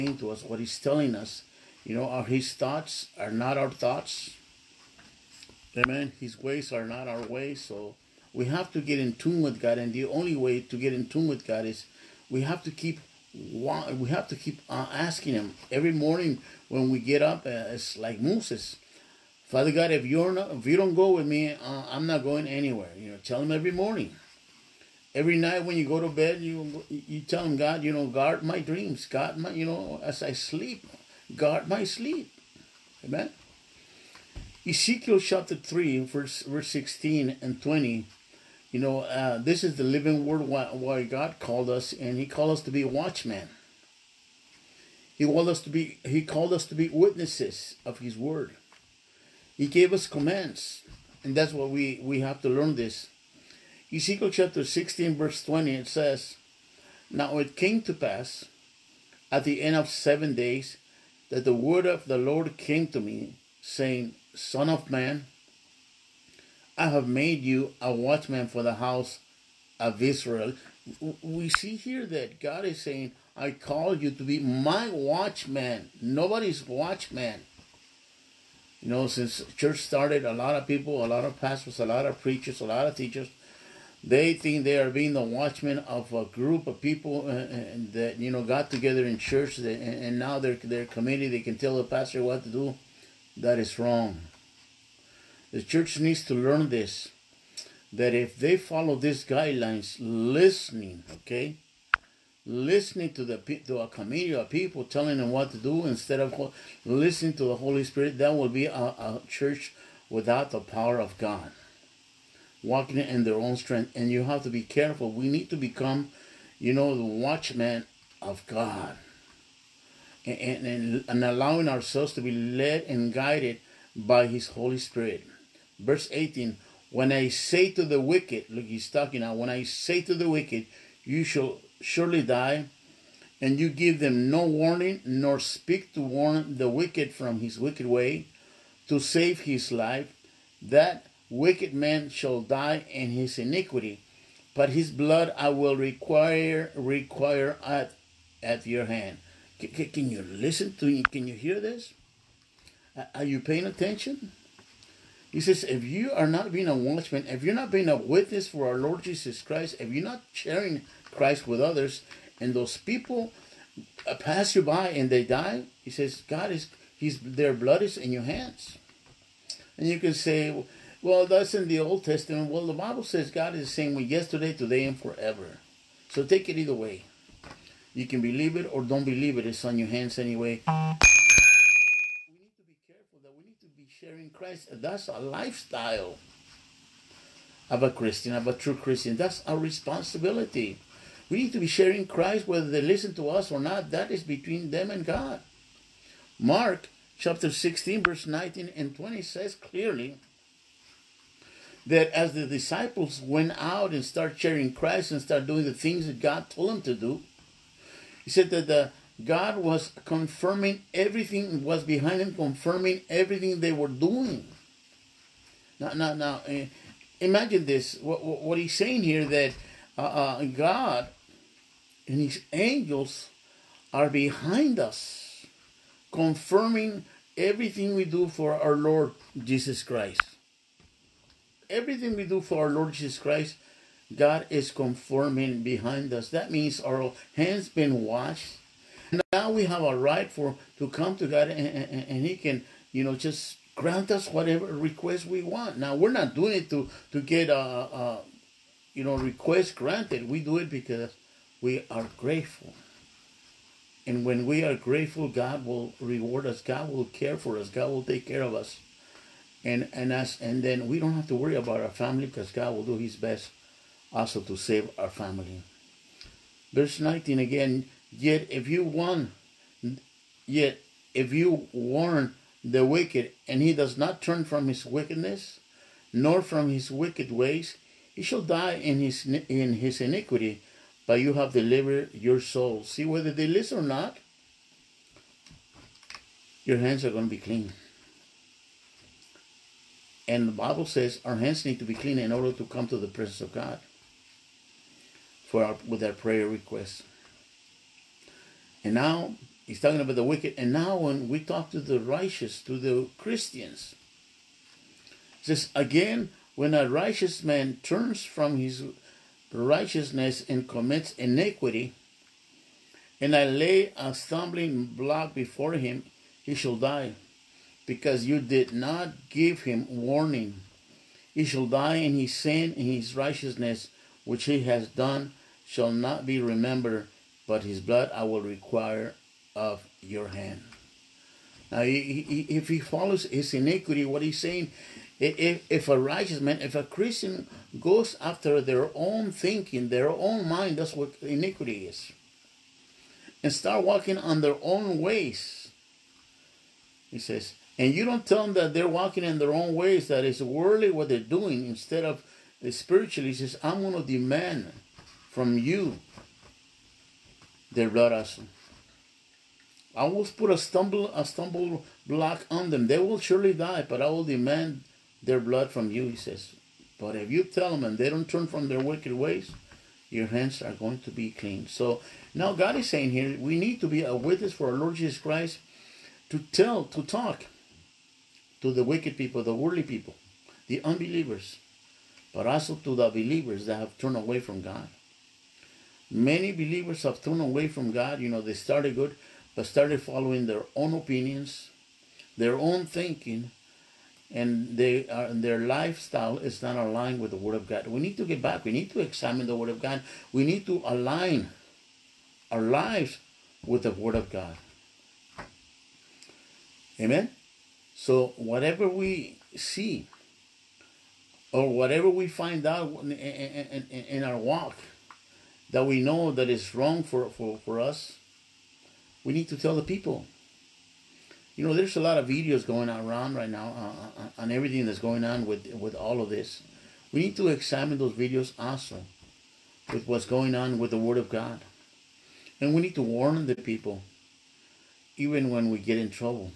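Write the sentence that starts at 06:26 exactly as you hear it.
Many believers have turned away from God.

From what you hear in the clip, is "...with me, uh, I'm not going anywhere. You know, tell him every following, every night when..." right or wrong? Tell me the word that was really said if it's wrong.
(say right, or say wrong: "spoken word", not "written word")
wrong: "morning", not "following".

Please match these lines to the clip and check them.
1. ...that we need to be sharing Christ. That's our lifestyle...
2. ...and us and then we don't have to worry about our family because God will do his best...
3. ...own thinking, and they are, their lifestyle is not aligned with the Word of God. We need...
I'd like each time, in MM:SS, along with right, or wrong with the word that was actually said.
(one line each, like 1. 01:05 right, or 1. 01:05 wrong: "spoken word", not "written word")
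1. 03:03 right
2. 04:19 right
3. 06:32 right.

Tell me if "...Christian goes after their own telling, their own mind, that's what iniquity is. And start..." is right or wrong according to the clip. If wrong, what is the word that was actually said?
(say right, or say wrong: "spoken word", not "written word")
wrong: "thinking", not "telling".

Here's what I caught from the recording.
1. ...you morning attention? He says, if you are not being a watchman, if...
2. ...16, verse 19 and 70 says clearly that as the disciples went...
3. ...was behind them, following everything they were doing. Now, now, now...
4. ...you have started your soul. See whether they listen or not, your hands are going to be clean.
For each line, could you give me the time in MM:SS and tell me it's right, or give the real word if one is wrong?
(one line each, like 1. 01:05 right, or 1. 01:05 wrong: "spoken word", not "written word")
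1. 02:33 wrong: "paying", not "morning"
2. 03:17 wrong: "20", not "70"
3. 03:31 wrong: "confirming", not "following"
4. 04:41 wrong: "delivered", not "started".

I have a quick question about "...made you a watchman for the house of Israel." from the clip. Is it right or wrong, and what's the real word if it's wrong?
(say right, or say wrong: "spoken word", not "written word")
right.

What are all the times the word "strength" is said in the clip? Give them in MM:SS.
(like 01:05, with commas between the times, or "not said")
01:53.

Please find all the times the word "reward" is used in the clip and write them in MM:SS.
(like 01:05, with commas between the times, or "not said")
04:16.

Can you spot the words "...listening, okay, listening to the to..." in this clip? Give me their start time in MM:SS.
01:39.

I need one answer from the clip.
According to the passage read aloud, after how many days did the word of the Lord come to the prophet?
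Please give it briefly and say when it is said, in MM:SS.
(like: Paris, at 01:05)
7, at 00:59.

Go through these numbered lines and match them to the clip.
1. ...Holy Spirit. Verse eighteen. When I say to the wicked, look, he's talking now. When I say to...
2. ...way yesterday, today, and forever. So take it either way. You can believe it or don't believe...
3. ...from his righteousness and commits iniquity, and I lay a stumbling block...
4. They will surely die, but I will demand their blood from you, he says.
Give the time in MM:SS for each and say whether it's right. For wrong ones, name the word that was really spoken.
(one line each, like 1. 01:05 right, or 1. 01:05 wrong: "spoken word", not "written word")
1. 02:04 right
2. 02:53 right
3. 05:08 right
4. 06:02 right.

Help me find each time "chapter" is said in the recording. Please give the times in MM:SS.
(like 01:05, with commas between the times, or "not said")
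00:35, 00:54, 03:17.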